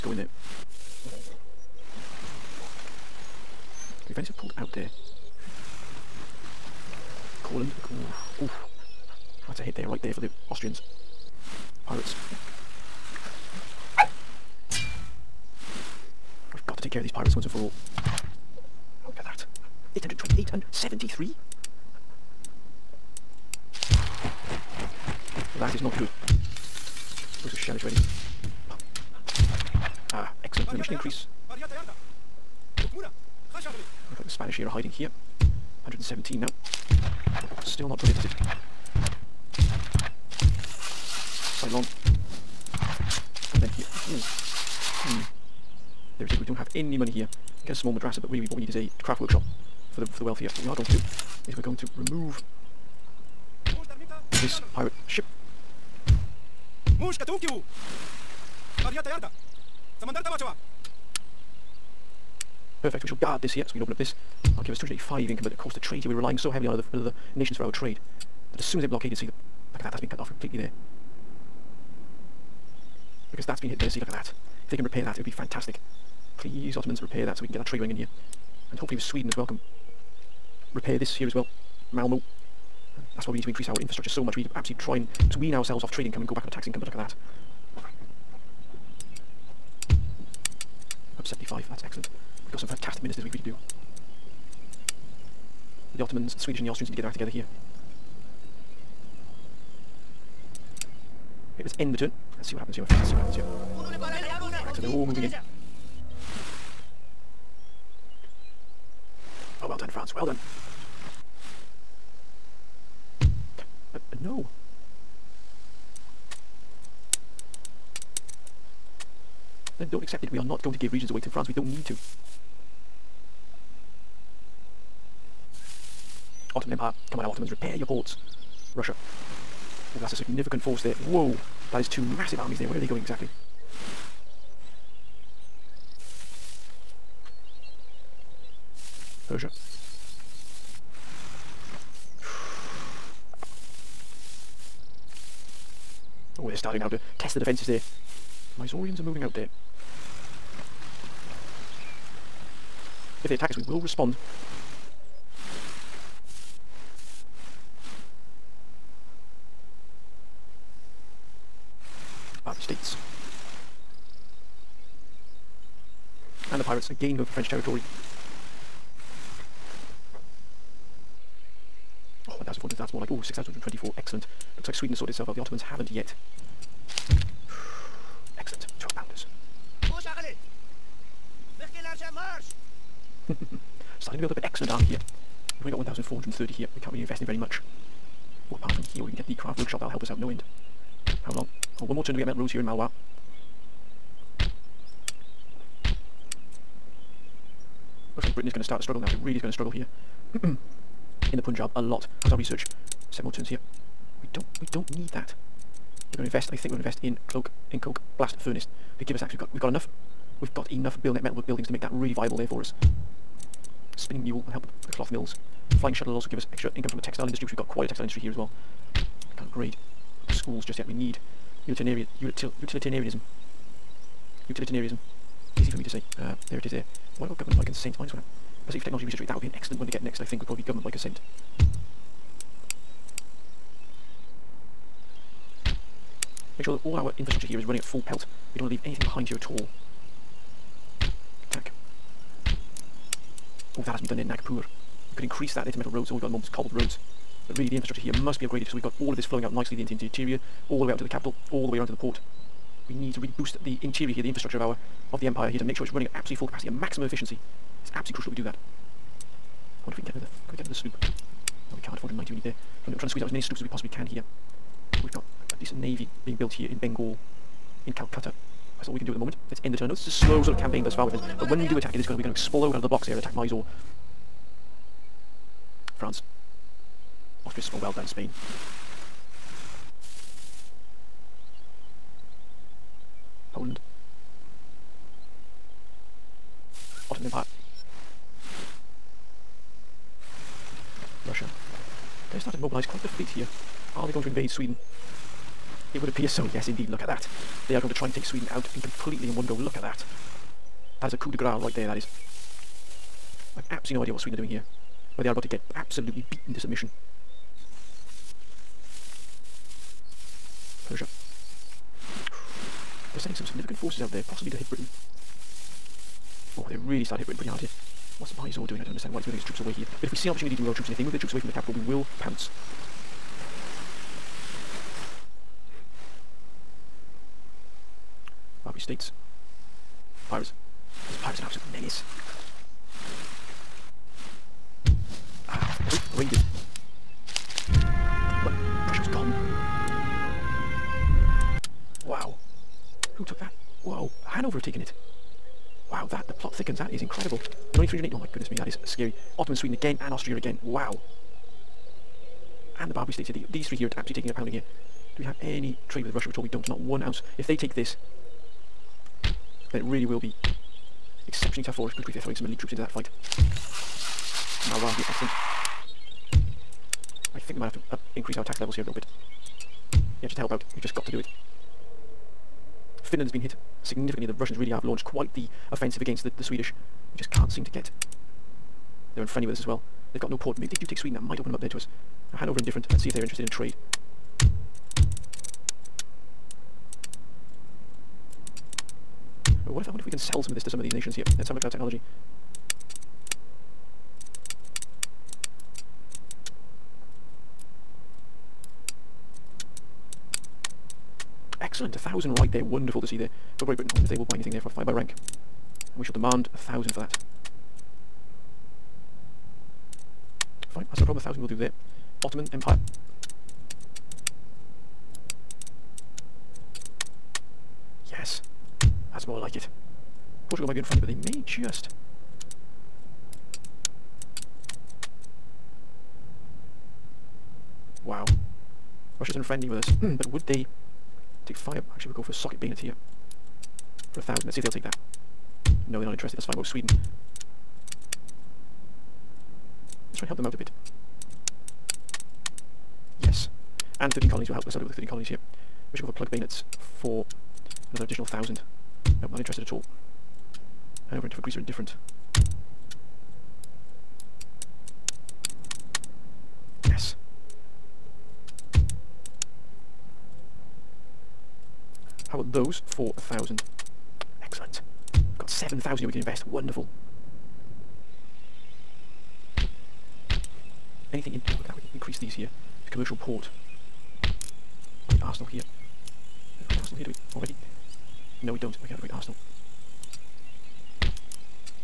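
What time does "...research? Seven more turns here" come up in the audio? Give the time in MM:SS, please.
03:22.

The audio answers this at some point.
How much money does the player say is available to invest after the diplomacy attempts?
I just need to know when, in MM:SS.
07:45.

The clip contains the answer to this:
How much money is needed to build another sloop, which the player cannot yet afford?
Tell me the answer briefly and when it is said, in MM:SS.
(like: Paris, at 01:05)
490, at 04:21.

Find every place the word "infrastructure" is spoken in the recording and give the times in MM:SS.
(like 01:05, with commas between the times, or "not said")
01:23, 03:57, 04:07, 04:14.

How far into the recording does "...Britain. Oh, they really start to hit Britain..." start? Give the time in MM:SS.
05:14.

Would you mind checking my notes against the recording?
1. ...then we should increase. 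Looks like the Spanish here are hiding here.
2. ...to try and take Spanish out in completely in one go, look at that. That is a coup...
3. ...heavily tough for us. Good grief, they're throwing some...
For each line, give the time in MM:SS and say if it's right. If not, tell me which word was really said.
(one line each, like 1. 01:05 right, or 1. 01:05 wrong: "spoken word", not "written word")
1. 00:30 right
2. 04:57 wrong: "Sweden", not "Spanish"
3. 06:01 wrong: "exceptionally", not "heavily".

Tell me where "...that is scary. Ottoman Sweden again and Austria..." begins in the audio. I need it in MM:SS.
05:48.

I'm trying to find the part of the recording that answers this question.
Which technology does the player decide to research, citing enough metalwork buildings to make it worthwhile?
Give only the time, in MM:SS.
03:27.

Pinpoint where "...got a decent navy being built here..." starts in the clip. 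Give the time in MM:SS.
04:25.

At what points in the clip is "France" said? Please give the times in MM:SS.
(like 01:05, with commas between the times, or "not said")
01:49, 02:01, 02:46, 04:36.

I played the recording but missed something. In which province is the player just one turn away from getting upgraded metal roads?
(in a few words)
Malwa.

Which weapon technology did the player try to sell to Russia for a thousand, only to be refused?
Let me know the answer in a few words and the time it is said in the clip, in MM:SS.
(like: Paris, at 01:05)
Socket bayonet, at 07:12.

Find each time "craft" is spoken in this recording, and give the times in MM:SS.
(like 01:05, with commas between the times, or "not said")
00:49, 03:09.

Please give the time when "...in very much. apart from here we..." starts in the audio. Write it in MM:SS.
03:07.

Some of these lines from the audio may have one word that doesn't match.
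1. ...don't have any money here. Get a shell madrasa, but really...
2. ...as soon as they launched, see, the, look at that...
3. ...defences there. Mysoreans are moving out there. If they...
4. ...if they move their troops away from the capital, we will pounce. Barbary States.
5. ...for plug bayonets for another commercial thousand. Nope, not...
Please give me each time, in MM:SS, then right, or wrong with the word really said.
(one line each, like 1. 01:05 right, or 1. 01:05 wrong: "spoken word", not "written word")
1. 00:46 wrong: "small", not "shell"
2. 01:08 wrong: "blockaded", not "launched"
3. 02:27 right
4. 05:20 right
5. 07:26 wrong: "additional", not "commercial".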